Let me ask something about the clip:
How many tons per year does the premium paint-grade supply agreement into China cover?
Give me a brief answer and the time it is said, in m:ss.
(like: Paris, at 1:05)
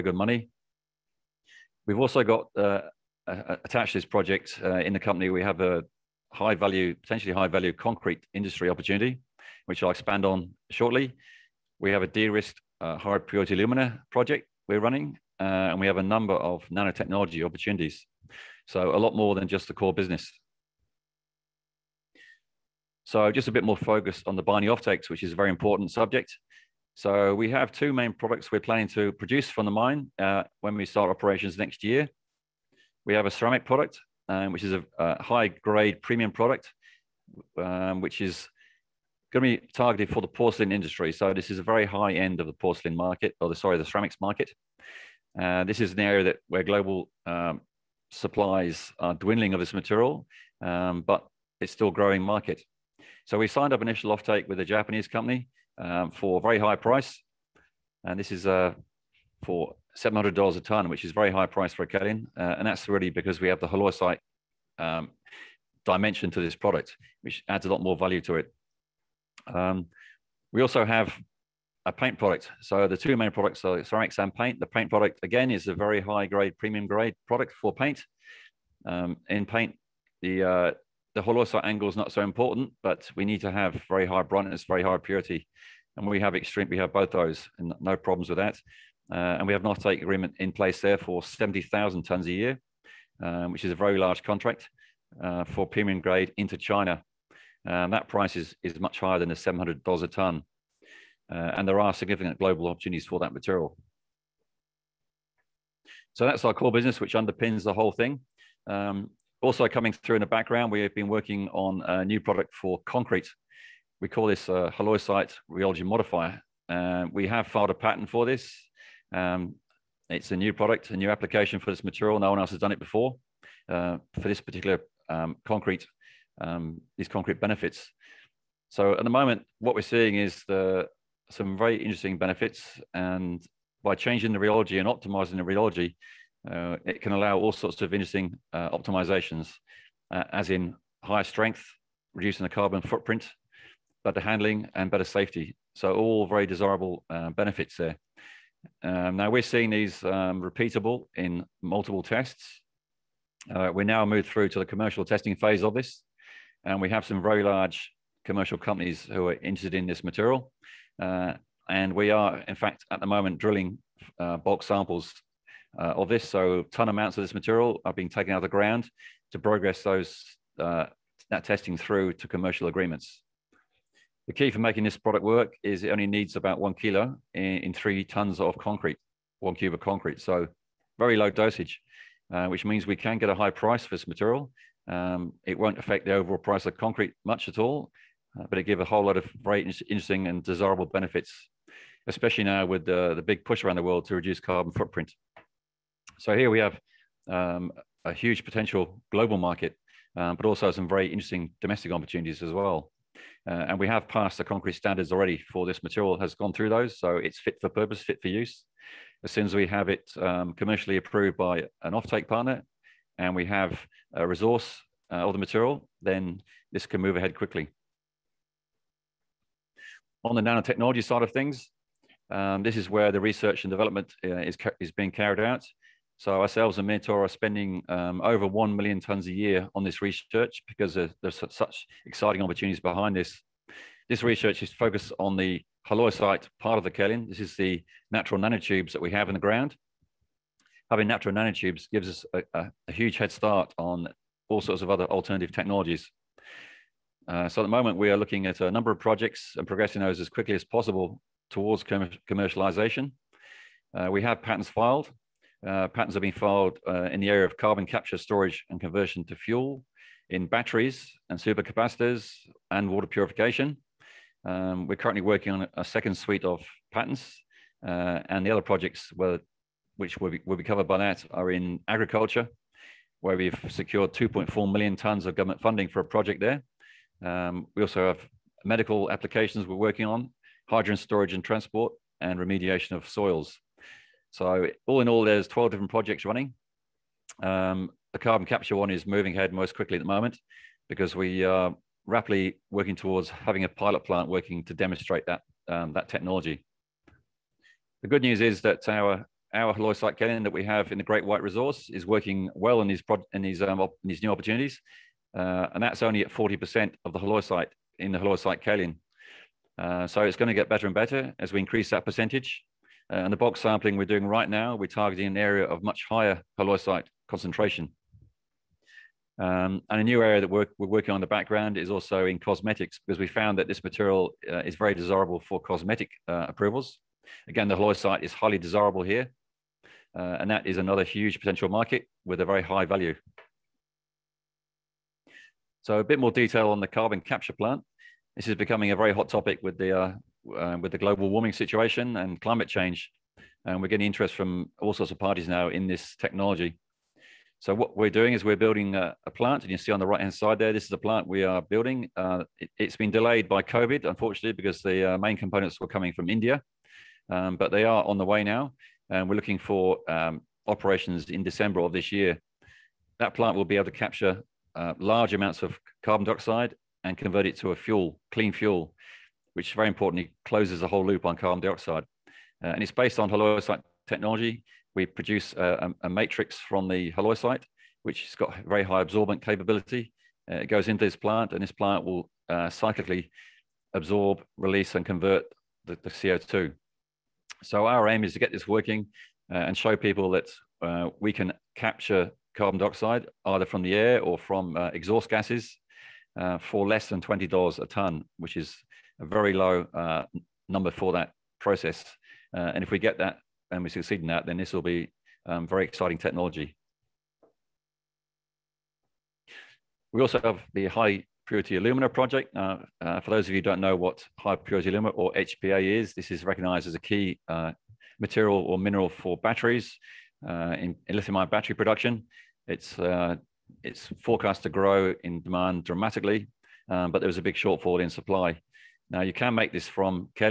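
70,000 tons, at 1:31.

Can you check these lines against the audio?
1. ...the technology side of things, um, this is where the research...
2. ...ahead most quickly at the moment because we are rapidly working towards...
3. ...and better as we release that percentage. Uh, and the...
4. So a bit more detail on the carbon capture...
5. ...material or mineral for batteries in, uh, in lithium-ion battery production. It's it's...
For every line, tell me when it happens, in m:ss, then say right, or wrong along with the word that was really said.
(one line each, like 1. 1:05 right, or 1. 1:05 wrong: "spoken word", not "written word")
1. 3:40 wrong: "nanotechnology", not "technology"
2. 4:49 right
3. 5:10 wrong: "increase", not "release"
4. 5:35 right
5. 6:58 right.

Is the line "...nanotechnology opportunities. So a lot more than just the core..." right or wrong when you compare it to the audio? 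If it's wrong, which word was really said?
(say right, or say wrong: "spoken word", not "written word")
right.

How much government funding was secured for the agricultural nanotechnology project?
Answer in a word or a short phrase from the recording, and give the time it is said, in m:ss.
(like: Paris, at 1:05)
2.4 million, at 4:34.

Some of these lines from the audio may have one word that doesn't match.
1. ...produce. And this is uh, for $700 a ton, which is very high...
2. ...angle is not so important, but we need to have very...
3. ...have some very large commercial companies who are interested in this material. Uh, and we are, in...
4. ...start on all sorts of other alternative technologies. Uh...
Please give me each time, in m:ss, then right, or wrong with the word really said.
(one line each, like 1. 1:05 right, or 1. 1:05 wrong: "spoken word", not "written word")
1. 0:56 wrong: "price", not "produce"
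2. 1:21 right
3. 2:36 right
4. 4:03 right.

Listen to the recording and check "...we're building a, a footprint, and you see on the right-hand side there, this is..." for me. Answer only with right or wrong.
wrong.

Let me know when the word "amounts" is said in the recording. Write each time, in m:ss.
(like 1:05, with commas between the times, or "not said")
2:46, 6:05.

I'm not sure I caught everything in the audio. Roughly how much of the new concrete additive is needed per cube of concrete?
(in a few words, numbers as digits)
1 kilo.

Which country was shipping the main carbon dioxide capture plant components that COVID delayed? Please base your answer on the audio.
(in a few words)
India.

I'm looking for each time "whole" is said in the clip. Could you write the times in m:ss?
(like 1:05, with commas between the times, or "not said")
1:47, 3:08, 6:10.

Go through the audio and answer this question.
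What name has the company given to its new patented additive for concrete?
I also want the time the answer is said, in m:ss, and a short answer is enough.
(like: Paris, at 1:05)
halloysite rheology modifier, at 1:54.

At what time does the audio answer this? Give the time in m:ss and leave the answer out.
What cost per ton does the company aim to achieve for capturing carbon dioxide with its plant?
6:36.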